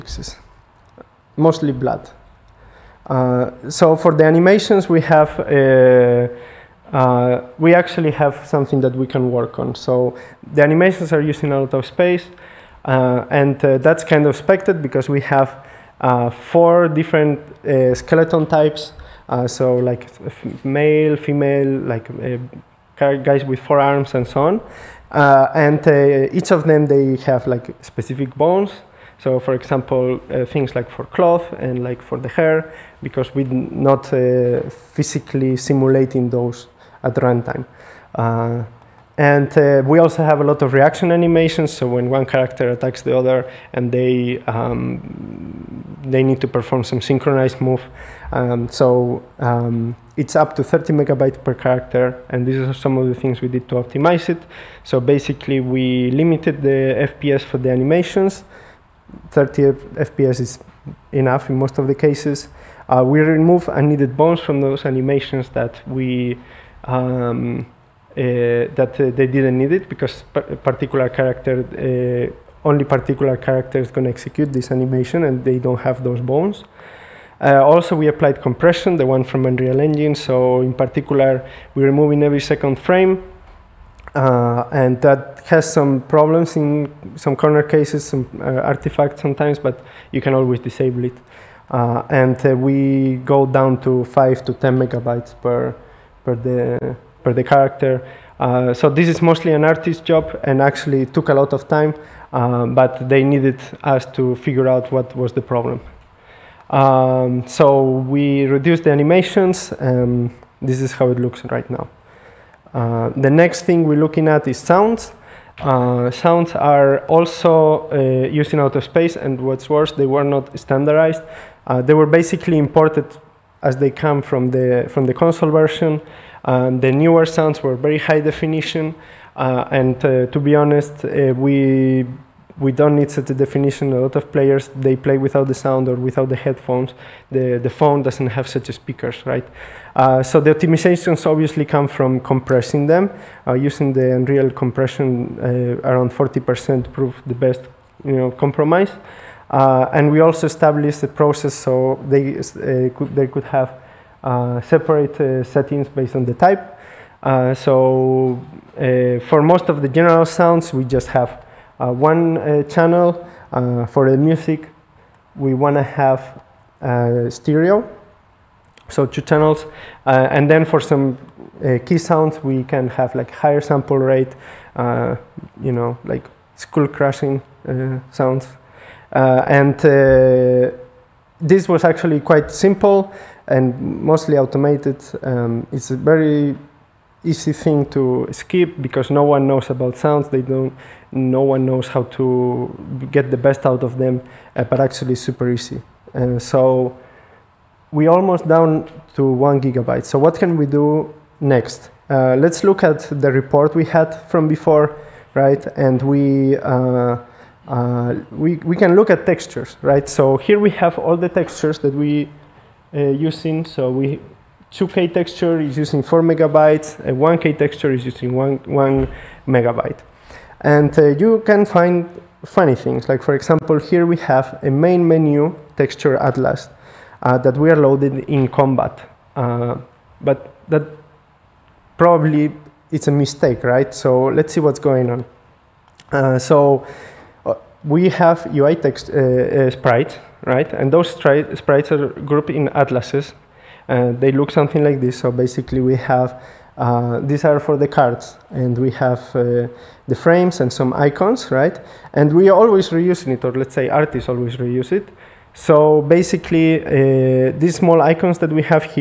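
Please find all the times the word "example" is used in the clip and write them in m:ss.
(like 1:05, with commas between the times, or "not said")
0:29, 3:43.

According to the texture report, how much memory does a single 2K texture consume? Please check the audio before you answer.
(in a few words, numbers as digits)
4 megabytes.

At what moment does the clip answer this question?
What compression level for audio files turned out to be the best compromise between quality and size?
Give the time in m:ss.
2:26.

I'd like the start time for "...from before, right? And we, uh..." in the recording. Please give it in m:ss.
3:24.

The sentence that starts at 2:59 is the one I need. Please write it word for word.
and this was actually quite simple and mostly automated.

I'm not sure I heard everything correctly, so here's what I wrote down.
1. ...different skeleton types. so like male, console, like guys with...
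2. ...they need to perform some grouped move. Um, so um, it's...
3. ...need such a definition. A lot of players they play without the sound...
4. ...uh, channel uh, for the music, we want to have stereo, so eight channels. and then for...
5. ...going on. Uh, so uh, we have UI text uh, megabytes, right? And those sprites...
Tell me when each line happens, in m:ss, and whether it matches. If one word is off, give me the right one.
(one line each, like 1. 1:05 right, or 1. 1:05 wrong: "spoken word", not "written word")
1. 0:16 wrong: "female", not "console"
2. 0:46 wrong: "synchronized", not "grouped"
3. 2:12 right
4. 2:42 wrong: "two", not "eight"
5. 3:54 wrong: "sprites", not "megabytes".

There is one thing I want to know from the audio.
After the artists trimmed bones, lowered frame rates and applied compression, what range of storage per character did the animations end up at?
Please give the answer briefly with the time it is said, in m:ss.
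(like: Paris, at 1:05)
5 to 10 megabytes, at 1:34.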